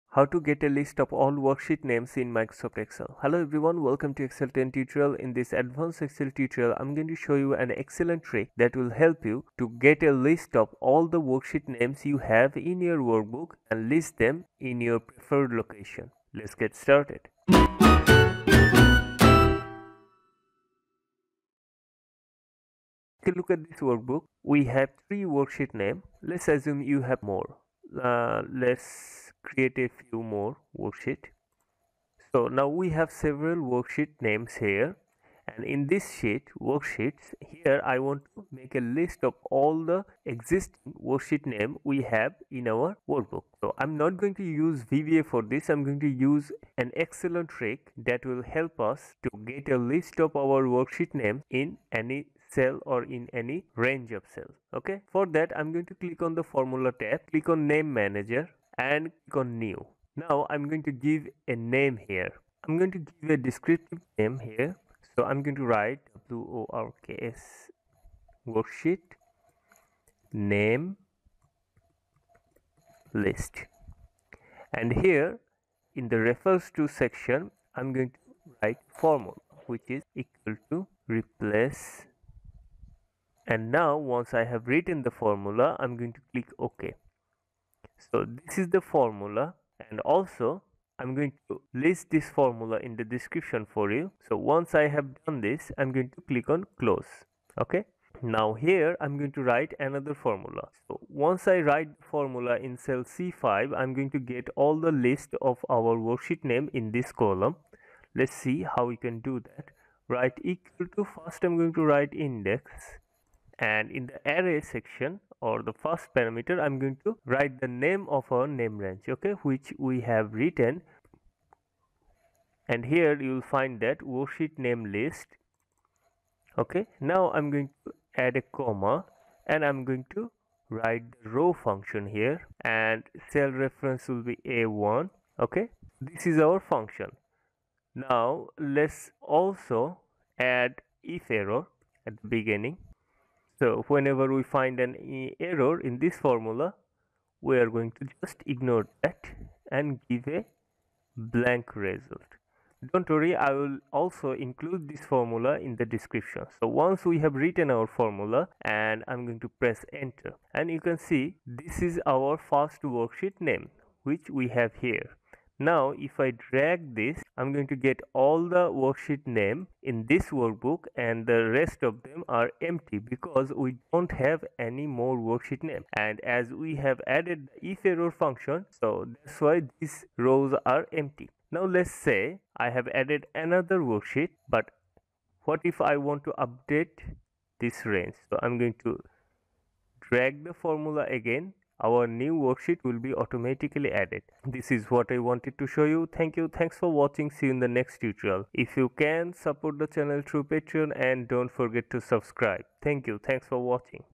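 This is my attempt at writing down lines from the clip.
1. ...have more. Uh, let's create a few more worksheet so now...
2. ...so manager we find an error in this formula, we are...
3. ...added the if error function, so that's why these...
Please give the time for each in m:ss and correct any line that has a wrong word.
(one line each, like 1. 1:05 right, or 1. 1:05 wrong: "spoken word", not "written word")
1. 0:27 right
2. 2:23 wrong: "whenever", not "manager"
3. 2:57 right.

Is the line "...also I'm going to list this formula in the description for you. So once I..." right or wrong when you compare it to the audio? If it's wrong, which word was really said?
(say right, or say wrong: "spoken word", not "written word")
right.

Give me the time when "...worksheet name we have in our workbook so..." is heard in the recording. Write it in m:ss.
0:41.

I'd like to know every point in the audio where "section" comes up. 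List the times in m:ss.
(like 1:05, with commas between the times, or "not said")
1:16, 1:54.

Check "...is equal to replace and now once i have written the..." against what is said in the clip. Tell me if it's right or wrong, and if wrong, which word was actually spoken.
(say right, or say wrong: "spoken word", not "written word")
right.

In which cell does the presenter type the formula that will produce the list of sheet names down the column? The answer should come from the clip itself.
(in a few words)
C5.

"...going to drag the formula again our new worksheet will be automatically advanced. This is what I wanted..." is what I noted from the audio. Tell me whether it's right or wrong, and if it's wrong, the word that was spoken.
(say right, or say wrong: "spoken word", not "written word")
wrong: "added", not "advanced".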